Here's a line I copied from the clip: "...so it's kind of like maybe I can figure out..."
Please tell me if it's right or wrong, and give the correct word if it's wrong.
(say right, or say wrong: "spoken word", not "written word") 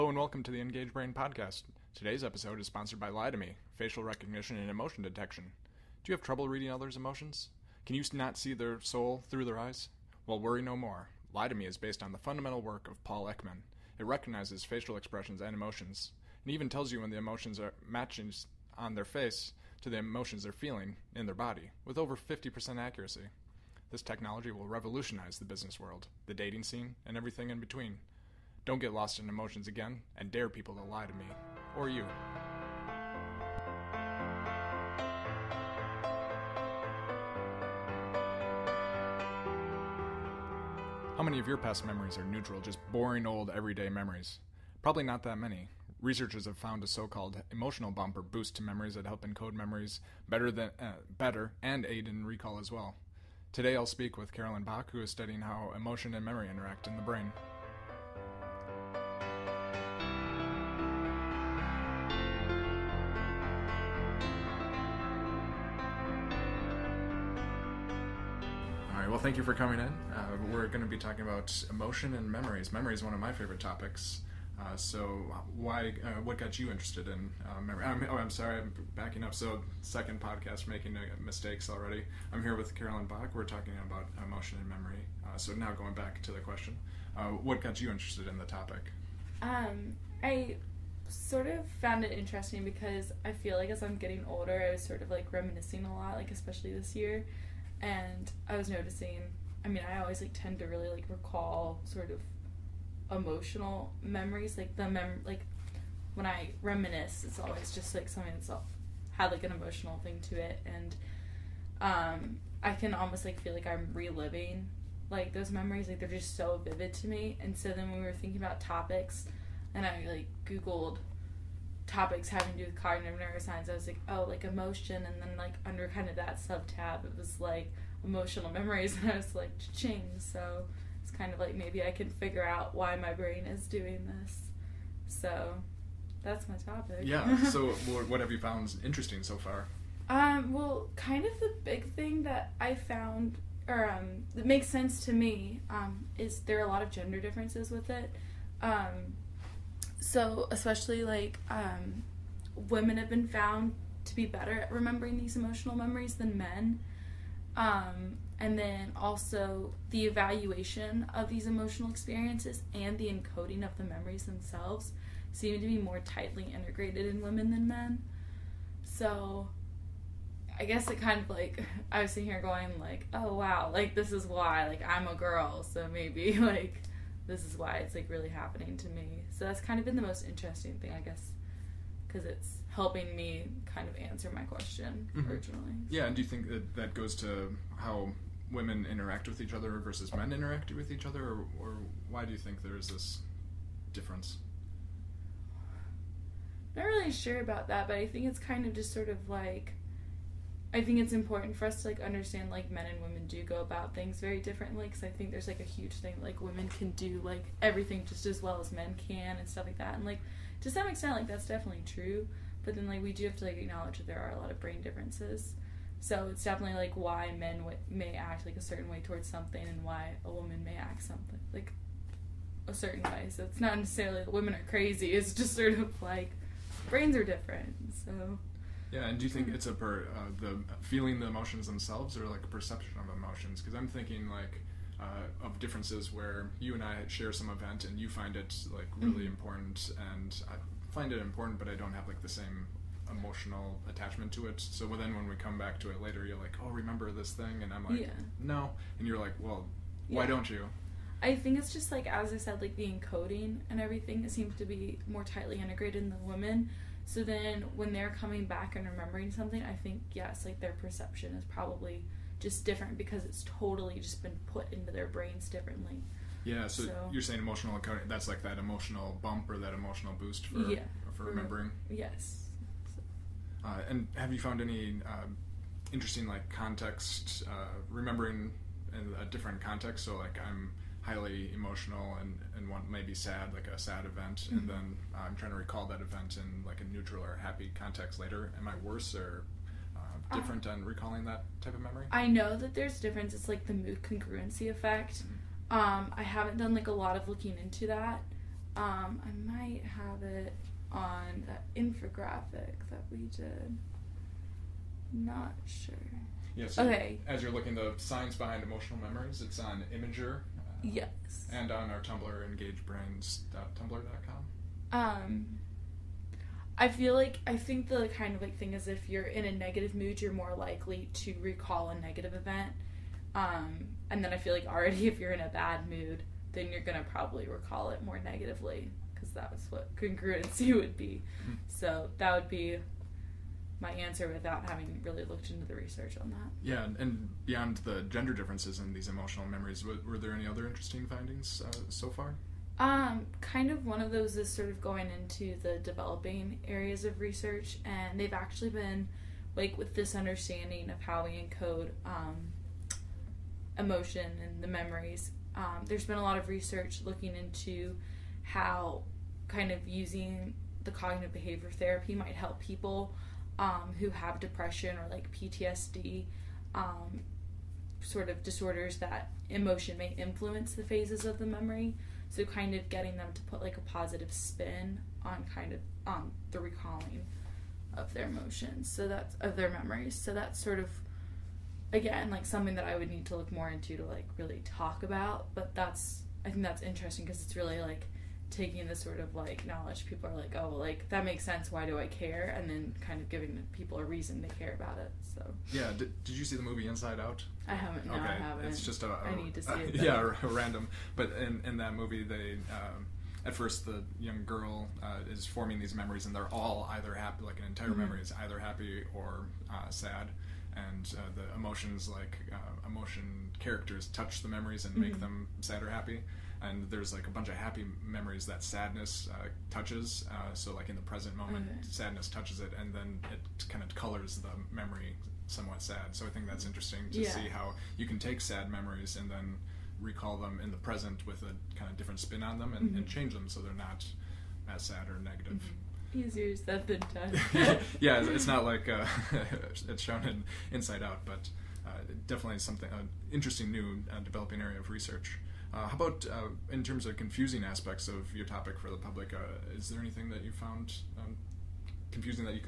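right.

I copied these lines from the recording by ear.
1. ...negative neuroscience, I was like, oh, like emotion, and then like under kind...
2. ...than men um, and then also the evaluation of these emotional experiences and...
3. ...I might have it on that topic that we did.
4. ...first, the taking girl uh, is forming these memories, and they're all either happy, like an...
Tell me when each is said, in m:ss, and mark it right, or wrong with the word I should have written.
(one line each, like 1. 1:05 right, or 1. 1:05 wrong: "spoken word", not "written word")
1. 2:02 wrong: "cognitive", not "negative"
2. 2:36 right
3. 4:59 wrong: "infographic", not "topic"
4. 6:43 wrong: "young", not "taking".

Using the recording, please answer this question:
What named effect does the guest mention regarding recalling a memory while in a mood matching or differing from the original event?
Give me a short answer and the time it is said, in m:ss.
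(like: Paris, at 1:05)
mood congruency effect, at 4:53.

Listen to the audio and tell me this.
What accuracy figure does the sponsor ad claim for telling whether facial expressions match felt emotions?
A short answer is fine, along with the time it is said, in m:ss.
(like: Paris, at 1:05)
over 50%, at 0:21.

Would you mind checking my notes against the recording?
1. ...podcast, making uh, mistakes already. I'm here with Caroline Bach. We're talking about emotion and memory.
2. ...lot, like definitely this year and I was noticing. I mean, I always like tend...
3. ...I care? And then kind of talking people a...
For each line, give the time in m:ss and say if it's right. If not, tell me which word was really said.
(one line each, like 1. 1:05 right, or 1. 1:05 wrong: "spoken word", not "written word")
1. 1:20 right
2. 1:35 wrong: "especially", not "definitely"
3. 6:31 wrong: "giving", not "talking".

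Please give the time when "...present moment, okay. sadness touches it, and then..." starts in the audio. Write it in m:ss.
7:01.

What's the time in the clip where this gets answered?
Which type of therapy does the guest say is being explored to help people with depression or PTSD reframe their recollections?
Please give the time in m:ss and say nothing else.
6:00.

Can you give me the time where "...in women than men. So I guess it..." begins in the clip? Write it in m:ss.
2:47.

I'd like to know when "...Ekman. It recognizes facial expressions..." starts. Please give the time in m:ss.
0:13.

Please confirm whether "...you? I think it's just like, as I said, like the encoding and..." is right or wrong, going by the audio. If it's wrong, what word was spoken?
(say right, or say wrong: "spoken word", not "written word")
right.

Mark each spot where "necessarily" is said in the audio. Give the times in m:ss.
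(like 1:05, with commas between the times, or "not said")
3:43.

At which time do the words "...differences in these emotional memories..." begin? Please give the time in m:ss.
5:38.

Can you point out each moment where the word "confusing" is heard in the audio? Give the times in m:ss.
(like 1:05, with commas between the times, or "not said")
7:27, 7:32.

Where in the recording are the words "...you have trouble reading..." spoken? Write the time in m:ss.
0:06.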